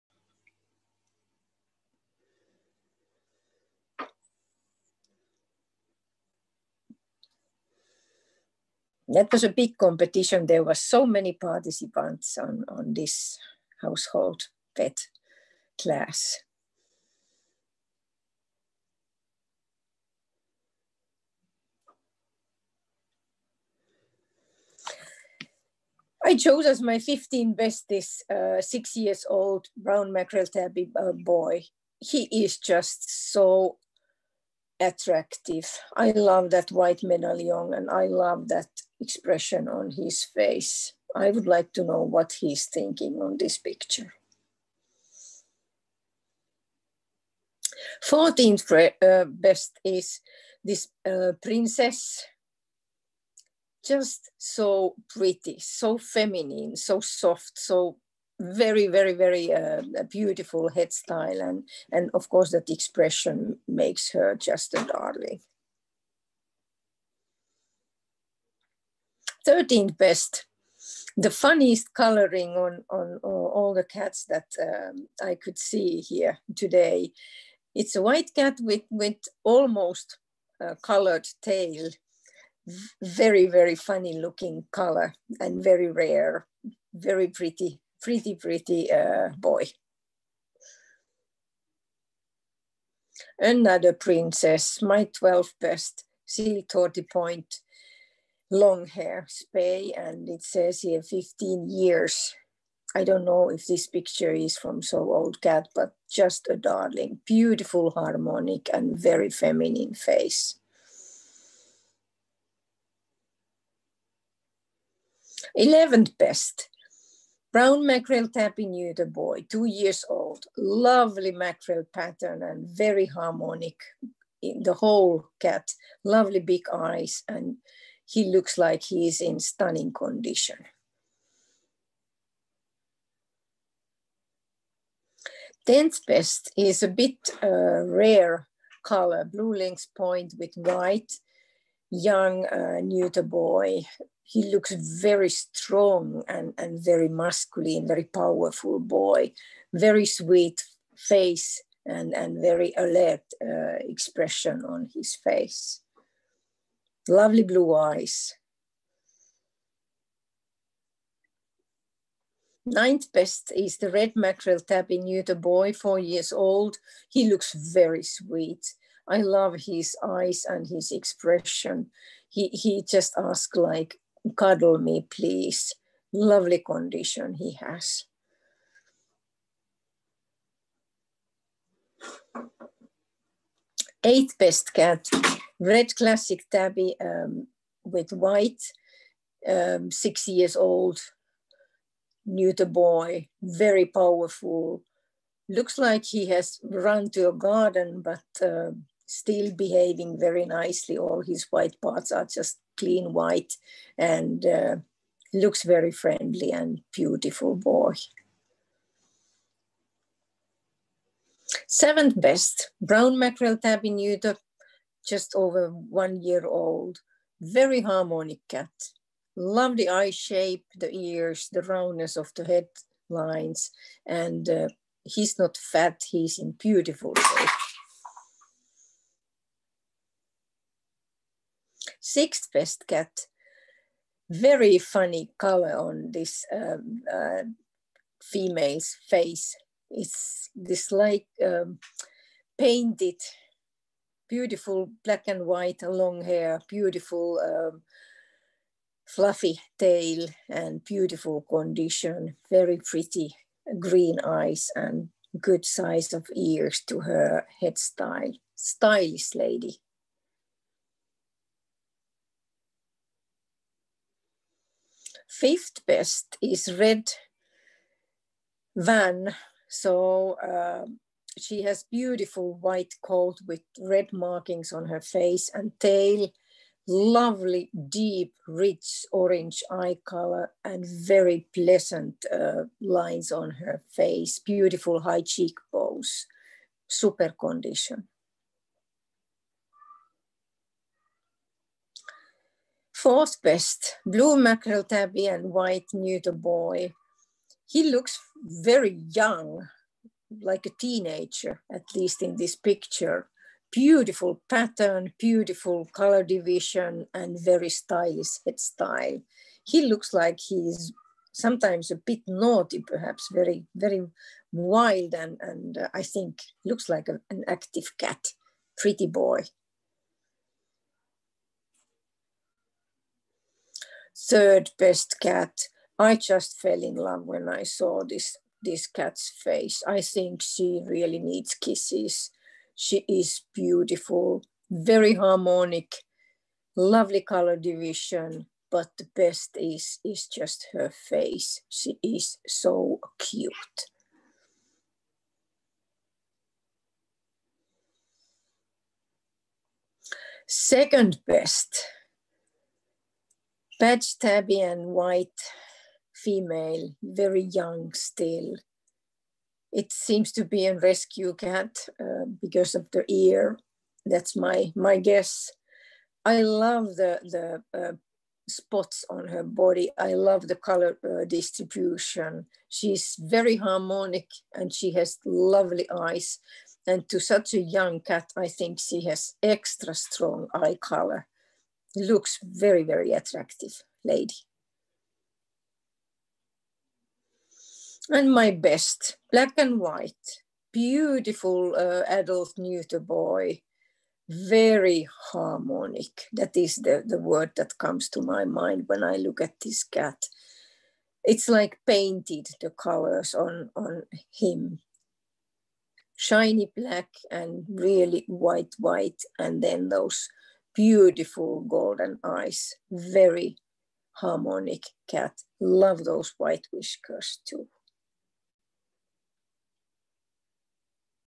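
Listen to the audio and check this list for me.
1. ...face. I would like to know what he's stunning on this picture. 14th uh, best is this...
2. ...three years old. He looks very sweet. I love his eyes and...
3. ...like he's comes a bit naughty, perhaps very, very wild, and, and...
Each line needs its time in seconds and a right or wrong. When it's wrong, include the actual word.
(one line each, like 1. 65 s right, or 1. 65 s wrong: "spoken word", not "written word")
1. 40 s wrong: "thinking", not "stunning"
2. 165 s wrong: "four", not "three"
3. 310 s wrong: "sometimes", not "comes".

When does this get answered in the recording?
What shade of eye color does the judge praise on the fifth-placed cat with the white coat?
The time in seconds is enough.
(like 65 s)
277 s.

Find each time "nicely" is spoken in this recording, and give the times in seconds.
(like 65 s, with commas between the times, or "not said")
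200 s.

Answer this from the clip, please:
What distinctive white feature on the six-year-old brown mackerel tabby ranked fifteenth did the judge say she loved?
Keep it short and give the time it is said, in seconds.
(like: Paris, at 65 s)
White medallion, at 36 s.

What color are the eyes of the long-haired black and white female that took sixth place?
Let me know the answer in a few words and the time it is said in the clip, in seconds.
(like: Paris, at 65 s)
Green, at 253 s.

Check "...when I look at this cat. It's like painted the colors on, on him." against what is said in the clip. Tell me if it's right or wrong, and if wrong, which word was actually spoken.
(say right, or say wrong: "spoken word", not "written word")
right.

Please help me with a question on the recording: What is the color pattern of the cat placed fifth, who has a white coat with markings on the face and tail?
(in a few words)
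Red Van.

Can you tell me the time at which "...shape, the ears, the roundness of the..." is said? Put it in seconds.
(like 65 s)
220 s.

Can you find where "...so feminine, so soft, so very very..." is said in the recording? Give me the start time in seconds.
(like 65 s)
55 s.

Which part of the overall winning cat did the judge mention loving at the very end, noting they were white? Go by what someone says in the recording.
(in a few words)
Whiskers.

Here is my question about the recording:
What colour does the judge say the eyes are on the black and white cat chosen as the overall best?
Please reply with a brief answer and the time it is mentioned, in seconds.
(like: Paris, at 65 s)
Golden, at 411 s.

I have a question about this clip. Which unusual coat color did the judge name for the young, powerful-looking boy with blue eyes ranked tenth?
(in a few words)
Blue lynx point with white.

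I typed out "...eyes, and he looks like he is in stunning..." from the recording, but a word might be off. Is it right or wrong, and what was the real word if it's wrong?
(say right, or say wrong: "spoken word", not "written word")
right.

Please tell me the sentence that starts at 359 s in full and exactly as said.
It seems to be a rescue cat uh, because of the ear.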